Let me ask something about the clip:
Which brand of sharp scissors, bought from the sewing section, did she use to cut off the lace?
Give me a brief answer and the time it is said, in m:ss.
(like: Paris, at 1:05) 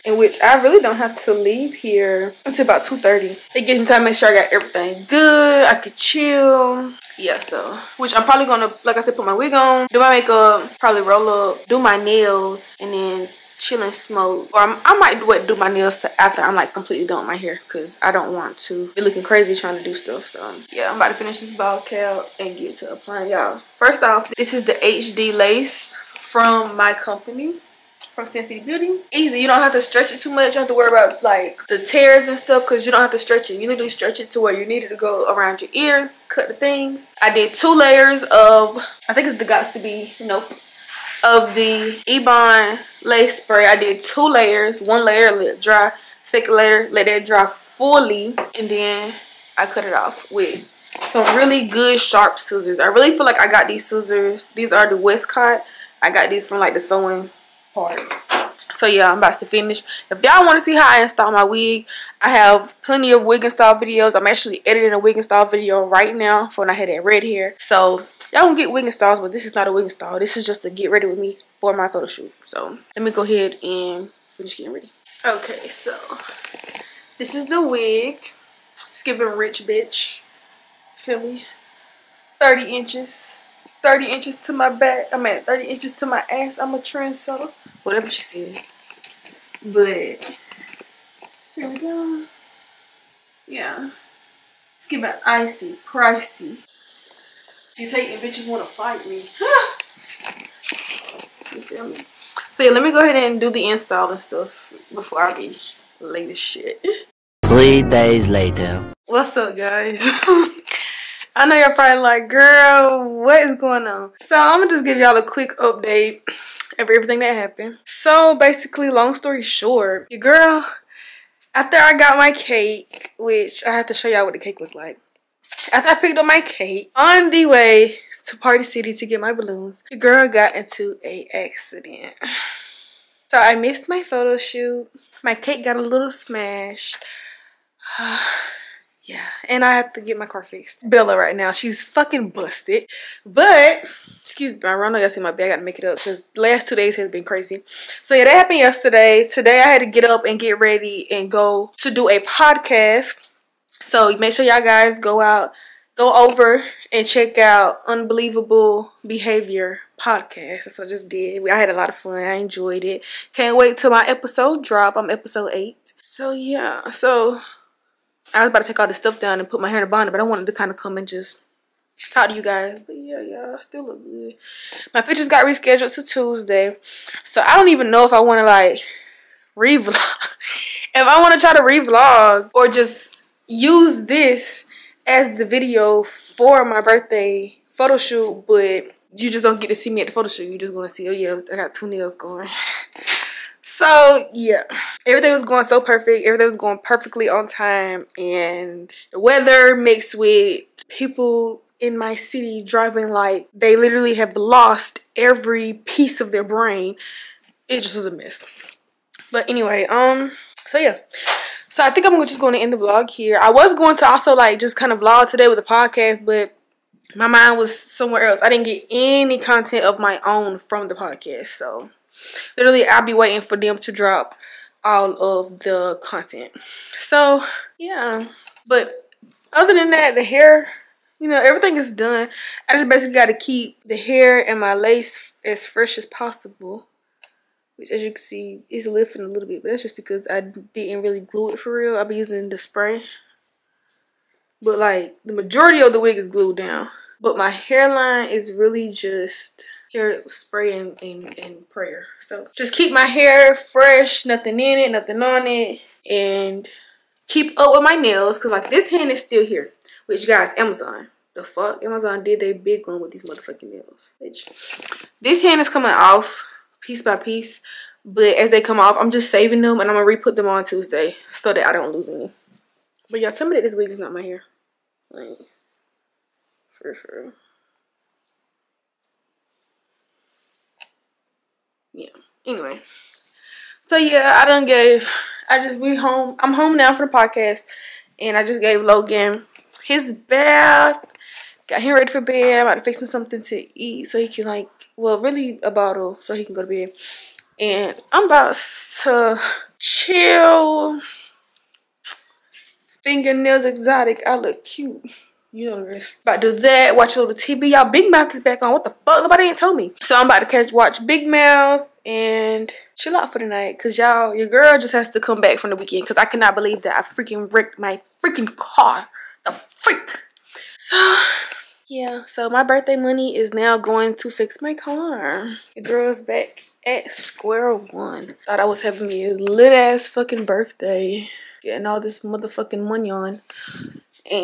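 Westcott, at 0:54.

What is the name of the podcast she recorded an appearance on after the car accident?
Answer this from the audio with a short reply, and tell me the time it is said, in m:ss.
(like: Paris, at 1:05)
Unbelievable Behavior, at 2:37.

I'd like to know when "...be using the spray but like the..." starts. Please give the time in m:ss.
4:02.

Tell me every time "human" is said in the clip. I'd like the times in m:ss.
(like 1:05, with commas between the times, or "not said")
not said.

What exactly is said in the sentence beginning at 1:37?
He's hating bitches want to fight me.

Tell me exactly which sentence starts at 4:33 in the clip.
But y'all, tell me that this wig is not my hair.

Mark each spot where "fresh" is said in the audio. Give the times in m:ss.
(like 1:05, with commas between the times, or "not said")
3:55, 4:13.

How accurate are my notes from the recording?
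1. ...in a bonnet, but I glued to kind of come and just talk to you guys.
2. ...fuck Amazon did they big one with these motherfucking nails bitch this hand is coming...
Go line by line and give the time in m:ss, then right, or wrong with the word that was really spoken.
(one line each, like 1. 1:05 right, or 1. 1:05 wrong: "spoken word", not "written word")
1. 2:49 wrong: "wanted", not "glued"
2. 4:21 right.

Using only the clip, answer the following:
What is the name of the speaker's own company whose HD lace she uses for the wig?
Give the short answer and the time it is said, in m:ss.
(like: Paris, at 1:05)
Cinn City Beauty, at 0:28.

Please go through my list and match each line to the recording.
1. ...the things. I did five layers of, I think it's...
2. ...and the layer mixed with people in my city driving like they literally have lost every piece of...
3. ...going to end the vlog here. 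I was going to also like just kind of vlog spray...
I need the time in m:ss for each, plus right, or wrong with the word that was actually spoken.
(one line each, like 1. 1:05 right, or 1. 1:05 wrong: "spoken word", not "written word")
1. 0:36 wrong: "two", not "five"
2. 3:18 wrong: "weather", not "layer"
3. 3:32 wrong: "today", not "spray".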